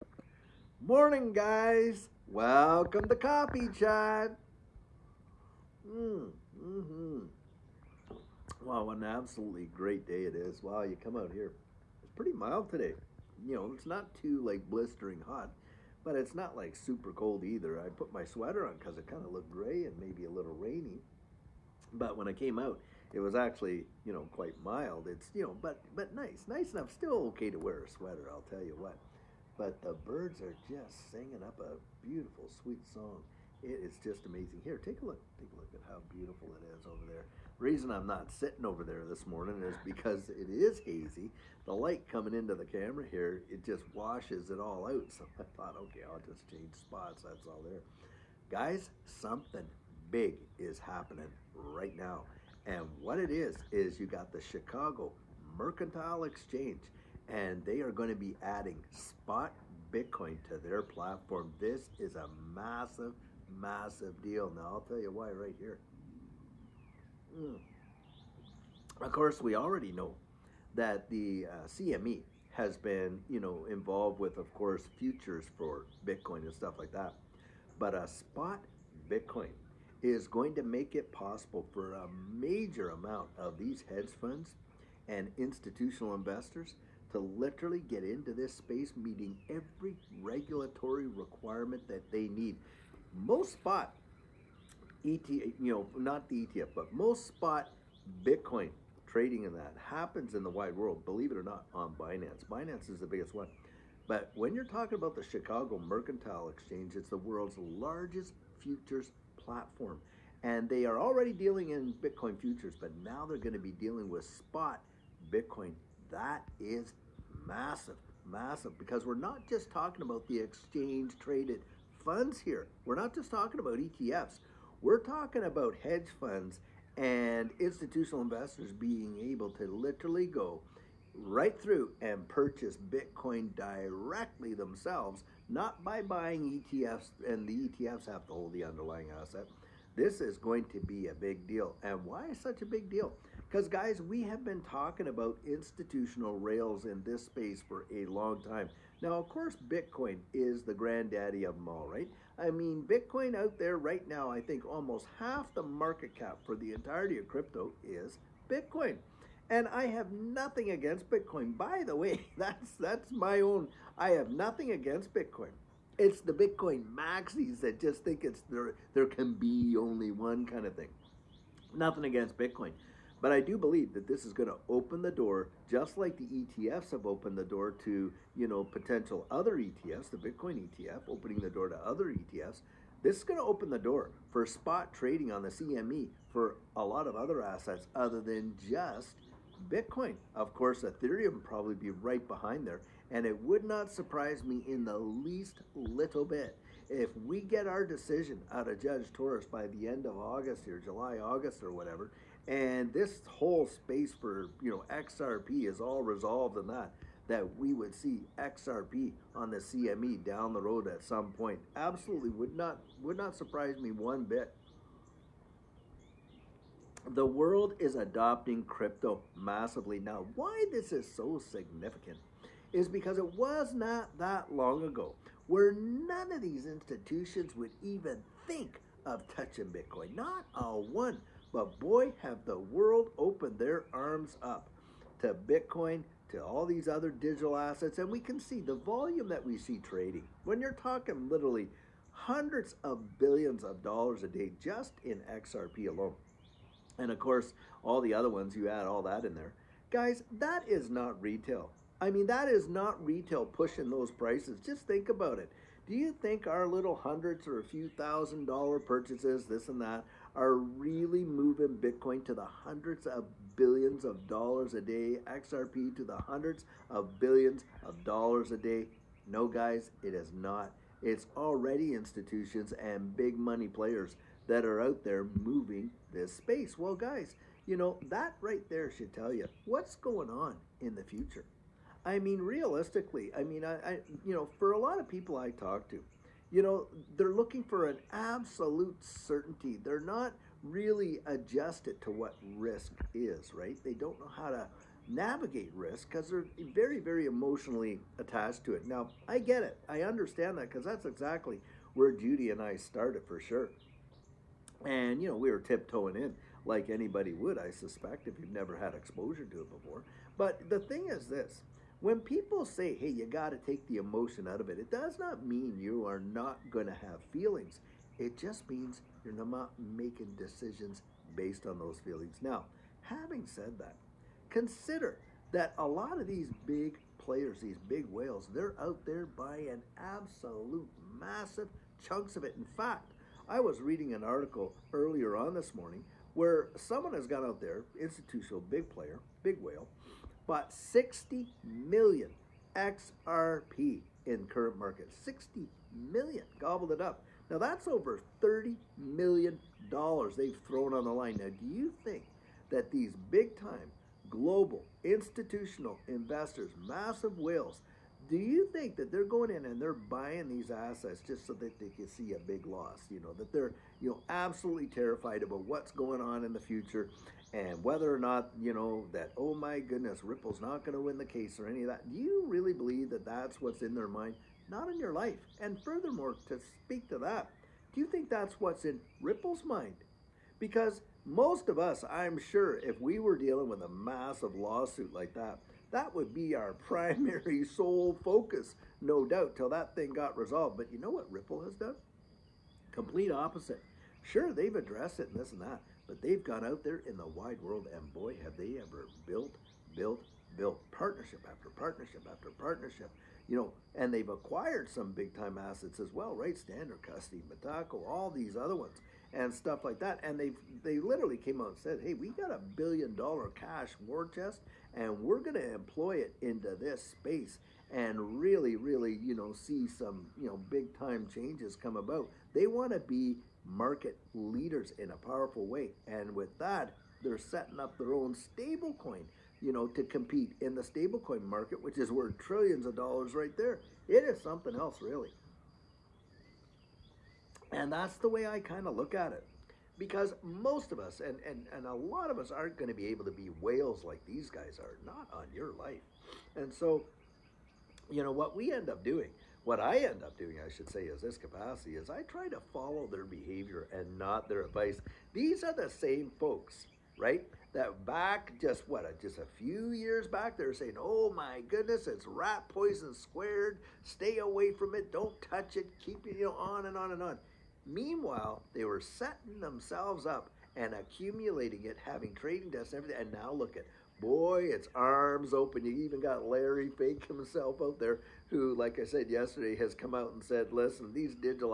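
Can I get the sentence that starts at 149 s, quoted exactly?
Now, of course, Bitcoin is the granddaddy of them all, right?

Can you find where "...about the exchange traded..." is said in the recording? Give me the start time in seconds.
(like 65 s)
120 s.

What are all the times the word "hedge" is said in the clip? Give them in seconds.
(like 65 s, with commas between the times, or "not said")
83 s, 125 s.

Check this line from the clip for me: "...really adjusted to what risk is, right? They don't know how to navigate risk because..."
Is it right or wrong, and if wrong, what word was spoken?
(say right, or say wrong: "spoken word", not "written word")
right.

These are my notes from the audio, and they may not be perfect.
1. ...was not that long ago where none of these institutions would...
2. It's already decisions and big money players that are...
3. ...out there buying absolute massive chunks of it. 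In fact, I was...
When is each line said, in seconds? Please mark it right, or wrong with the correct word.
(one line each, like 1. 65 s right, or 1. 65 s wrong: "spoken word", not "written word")
1. 223 s right
2. 271 s wrong: "institutions", not "decisions"
3. 328 s right.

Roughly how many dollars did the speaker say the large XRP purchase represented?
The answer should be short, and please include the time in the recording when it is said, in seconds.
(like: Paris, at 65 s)
Over $30 million, at 347 s.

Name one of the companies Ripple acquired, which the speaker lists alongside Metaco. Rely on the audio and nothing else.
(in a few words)
Standard Custody.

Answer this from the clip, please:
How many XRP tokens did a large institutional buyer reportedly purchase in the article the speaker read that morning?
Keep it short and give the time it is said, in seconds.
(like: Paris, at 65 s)
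60 million, at 340 s.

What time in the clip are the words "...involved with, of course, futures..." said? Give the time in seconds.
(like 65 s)
73 s.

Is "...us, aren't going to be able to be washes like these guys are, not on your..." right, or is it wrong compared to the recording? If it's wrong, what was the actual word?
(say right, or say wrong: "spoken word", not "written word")
wrong: "whales", not "washes".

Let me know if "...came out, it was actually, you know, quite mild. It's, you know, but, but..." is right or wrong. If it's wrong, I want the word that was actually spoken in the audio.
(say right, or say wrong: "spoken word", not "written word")
right.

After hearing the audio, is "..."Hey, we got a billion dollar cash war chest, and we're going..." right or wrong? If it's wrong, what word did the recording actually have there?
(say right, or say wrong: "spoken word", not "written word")
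right.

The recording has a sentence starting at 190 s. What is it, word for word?
Of course, Ethereum probably be right behind there.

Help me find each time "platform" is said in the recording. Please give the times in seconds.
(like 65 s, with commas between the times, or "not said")
60 s, 109 s.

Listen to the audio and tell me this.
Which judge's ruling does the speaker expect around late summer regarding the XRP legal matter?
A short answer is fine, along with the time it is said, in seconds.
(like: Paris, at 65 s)
Judge Torres, at 198 s.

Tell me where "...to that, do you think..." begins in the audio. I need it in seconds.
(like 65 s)
377 s.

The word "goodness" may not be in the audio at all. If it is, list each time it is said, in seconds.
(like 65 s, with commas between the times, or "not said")
369 s, 461 s.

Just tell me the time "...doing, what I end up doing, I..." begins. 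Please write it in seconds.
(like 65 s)
449 s.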